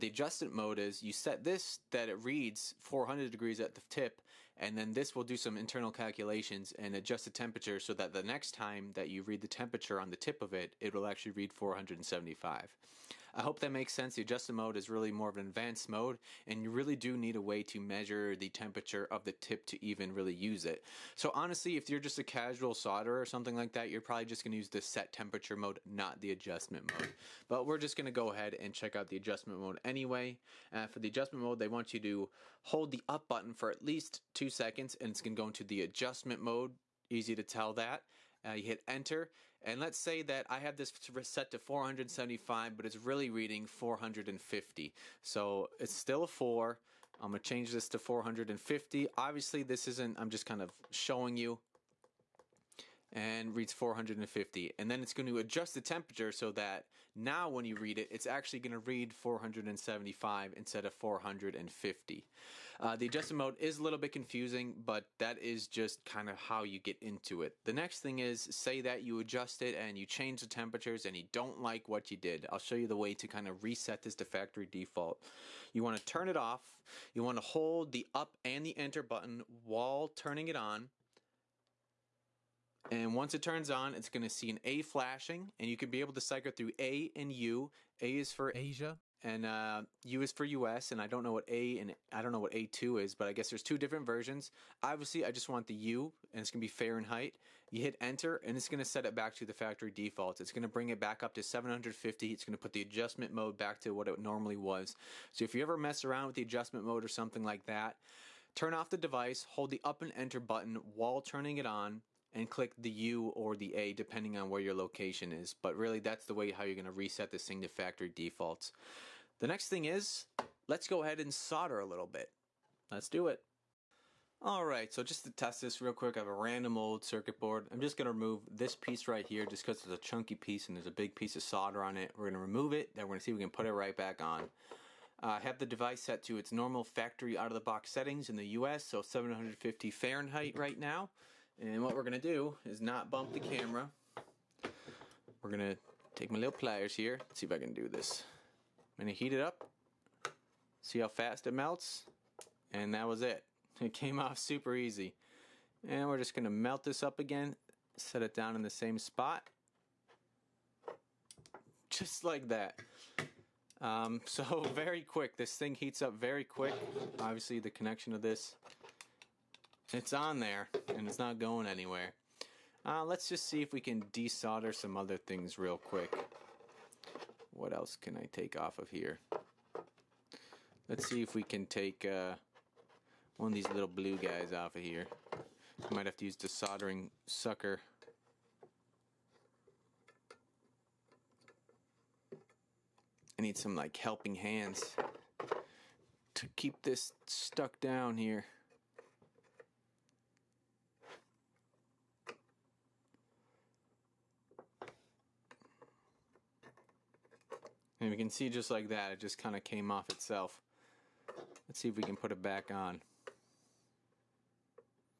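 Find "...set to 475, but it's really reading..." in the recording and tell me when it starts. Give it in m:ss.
0:40.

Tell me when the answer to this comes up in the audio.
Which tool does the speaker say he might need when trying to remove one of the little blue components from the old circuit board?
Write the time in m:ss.
3:06.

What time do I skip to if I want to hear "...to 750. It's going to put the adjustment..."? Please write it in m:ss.
1:41.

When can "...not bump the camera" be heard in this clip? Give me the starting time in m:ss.
2:22.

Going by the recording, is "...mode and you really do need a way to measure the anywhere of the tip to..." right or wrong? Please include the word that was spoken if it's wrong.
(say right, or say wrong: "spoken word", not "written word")
wrong: "temperature", not "anywhere".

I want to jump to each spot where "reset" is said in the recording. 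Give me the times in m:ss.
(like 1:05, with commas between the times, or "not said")
1:13, 1:56.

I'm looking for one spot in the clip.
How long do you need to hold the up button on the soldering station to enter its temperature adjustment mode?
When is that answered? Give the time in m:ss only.
0:34.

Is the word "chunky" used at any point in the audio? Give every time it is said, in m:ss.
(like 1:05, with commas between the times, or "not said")
2:09.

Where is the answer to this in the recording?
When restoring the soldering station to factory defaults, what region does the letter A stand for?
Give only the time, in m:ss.
1:28.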